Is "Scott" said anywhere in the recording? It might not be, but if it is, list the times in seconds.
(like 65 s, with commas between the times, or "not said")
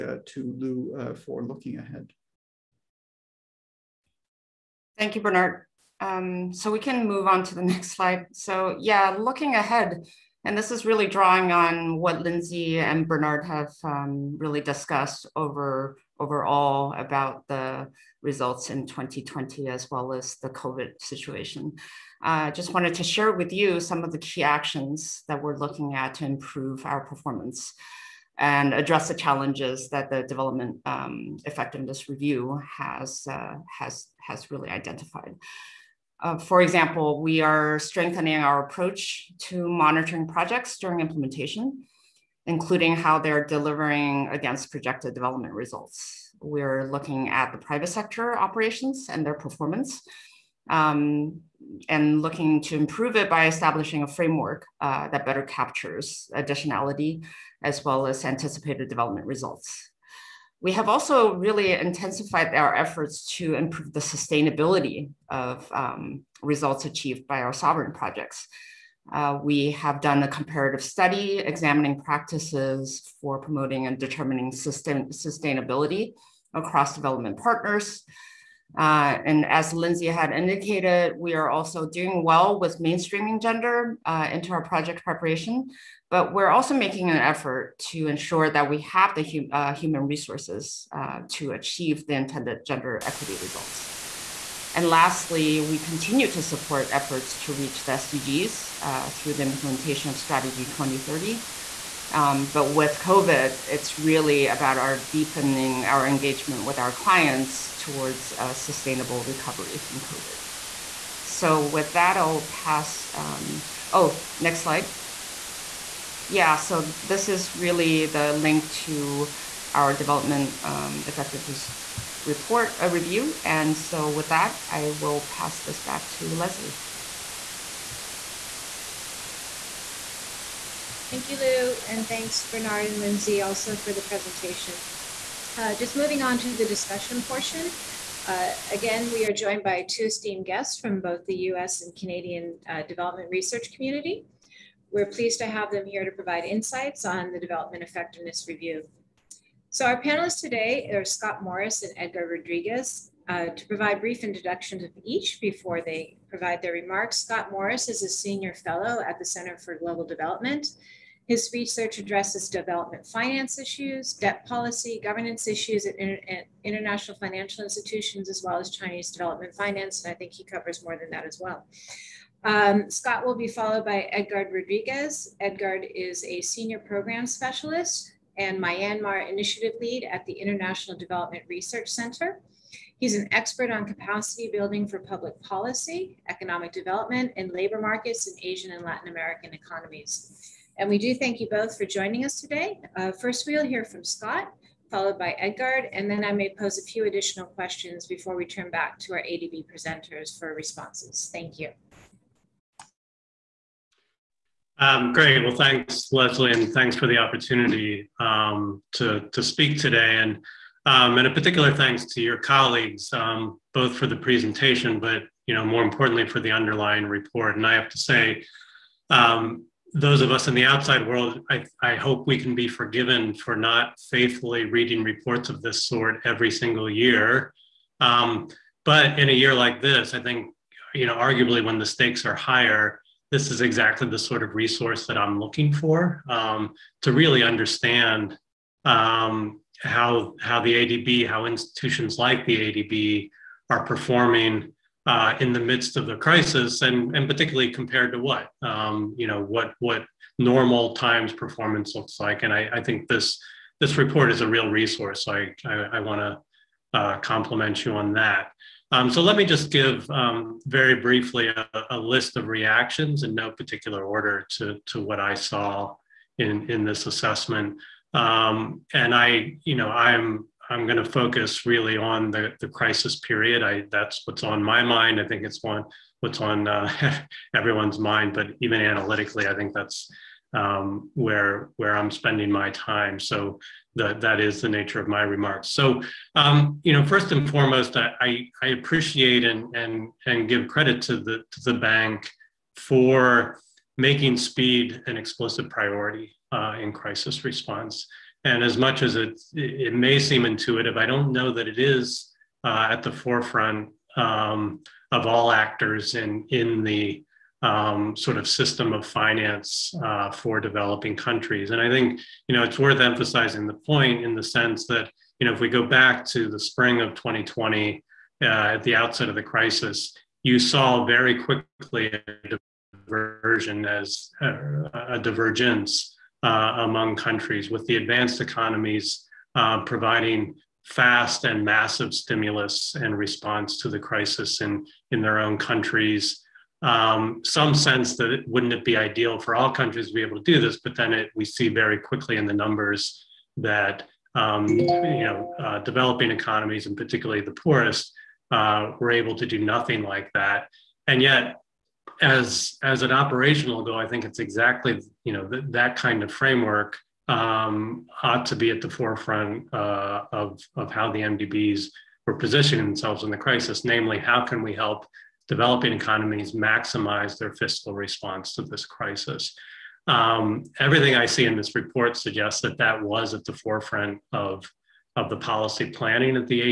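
151 s, 157 s, 172 s, 194 s.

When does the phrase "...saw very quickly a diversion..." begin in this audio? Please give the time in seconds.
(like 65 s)
320 s.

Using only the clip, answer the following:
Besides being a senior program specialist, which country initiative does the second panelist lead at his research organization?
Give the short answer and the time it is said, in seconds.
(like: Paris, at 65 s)
Myanmar, at 178 s.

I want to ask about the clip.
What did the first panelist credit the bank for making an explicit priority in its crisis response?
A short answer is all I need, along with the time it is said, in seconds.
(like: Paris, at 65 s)
speed, at 294 s.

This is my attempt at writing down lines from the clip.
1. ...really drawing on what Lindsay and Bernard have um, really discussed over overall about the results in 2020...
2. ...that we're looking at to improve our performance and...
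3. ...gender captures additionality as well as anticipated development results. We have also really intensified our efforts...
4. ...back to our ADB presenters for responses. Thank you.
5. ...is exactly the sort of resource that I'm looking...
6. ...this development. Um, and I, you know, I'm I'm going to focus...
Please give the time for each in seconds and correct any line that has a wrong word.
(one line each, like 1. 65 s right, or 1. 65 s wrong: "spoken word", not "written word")
1. 10 s right
2. 25 s right
3. 55 s wrong: "better", not "gender"
4. 198 s right
5. 233 s right
6. 266 s wrong: "assessment", not "development".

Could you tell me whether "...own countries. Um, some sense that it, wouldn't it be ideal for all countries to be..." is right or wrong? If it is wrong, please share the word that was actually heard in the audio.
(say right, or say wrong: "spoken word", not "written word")
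right.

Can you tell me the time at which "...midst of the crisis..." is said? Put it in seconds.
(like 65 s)
245 s.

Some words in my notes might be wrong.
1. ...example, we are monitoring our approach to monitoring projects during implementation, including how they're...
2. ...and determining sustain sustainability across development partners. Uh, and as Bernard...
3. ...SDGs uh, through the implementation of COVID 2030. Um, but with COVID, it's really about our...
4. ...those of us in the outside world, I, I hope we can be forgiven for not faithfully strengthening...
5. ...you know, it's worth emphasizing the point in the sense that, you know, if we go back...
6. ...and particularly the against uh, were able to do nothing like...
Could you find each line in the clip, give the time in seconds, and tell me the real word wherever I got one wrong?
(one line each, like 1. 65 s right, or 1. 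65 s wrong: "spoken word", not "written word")
1. 36 s wrong: "strengthening", not "monitoring"
2. 73 s wrong: "Lindsay", not "Bernard"
3. 97 s wrong: "Strategy", not "COVID"
4. 219 s wrong: "reading", not "strengthening"
5. 312 s right
6. 346 s wrong: "poorest", not "against".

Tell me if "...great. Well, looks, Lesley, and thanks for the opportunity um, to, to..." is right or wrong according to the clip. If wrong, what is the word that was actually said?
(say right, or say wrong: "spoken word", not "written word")
wrong: "thanks", not "looks".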